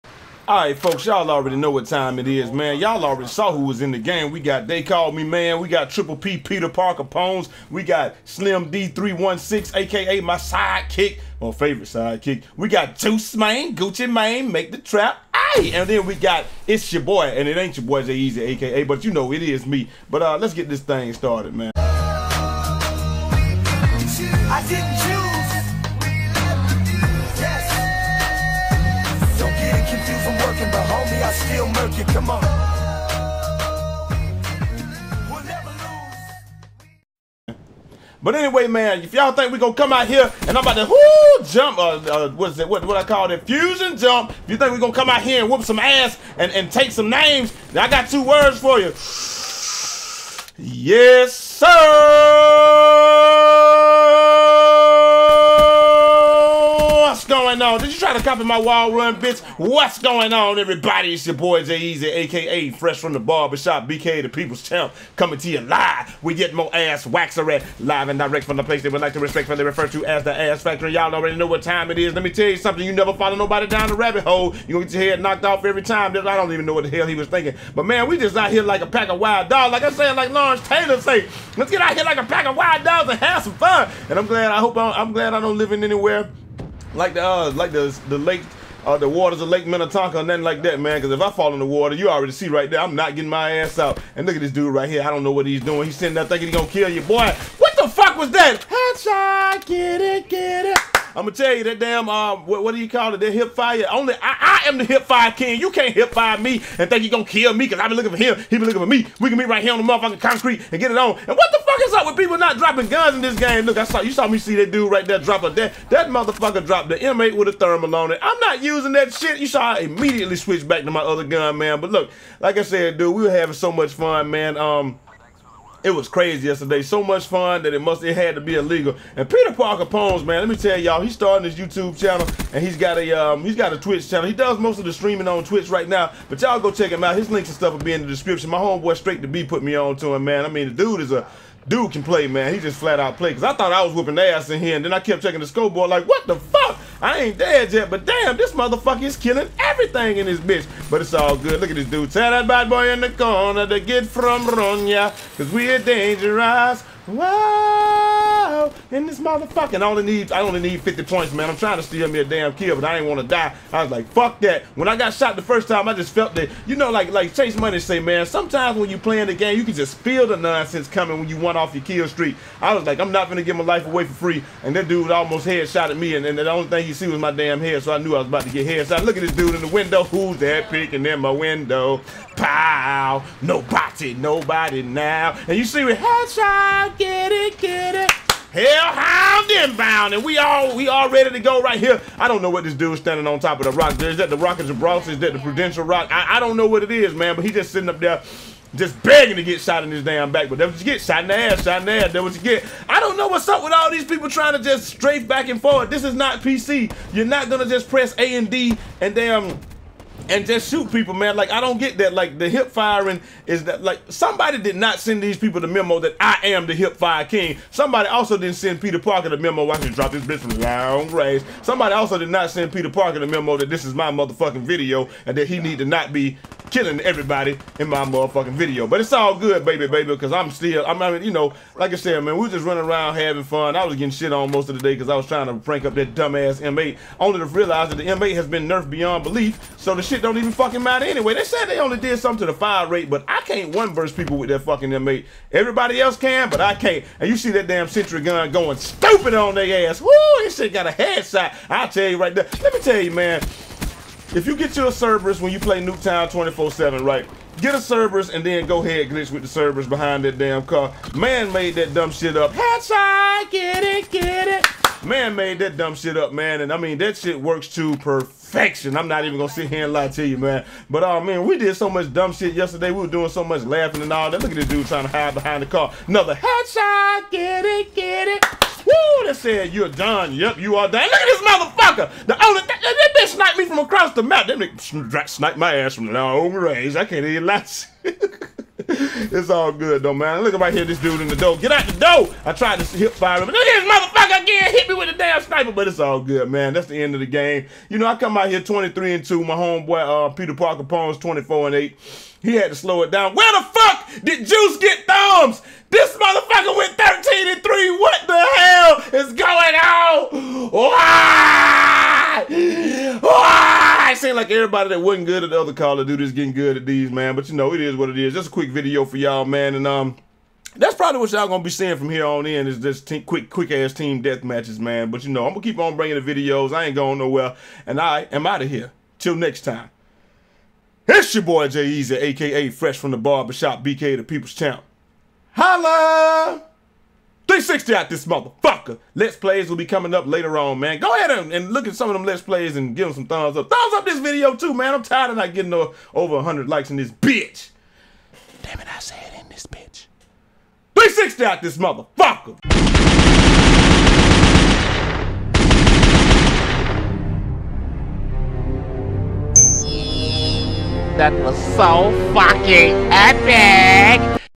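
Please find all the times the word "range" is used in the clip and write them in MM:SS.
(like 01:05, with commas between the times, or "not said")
03:41, 04:46.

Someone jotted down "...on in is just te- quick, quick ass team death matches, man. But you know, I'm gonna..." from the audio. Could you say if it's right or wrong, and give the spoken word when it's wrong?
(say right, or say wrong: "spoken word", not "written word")
right.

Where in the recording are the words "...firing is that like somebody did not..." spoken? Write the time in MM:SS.
03:32.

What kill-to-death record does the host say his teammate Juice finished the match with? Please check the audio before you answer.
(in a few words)
13 and 3.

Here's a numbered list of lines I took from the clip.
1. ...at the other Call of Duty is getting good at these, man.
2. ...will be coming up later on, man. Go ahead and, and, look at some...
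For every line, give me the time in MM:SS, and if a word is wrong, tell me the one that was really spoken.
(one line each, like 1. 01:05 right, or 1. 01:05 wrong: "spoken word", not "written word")
1. 05:15 right
2. 05:39 right.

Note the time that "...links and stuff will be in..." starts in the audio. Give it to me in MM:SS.
02:17.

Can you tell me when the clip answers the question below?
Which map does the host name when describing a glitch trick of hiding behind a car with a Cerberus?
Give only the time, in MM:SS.
04:15.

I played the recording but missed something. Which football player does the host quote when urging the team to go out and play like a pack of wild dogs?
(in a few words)
Lawrence Taylor.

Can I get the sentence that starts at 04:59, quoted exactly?
My homeboy uh, Peter Parker PWNZ 24 and 8.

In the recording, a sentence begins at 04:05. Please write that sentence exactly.
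Everybody else can, but I can't.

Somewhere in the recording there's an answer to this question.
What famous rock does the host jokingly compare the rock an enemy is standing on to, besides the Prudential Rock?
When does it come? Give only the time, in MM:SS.
03:14.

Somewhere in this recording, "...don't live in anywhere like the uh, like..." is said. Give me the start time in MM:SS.
01:25.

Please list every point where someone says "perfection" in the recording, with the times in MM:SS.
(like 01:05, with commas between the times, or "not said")
04:27.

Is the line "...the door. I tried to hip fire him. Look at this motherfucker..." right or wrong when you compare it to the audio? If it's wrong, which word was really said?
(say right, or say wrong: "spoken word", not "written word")
right.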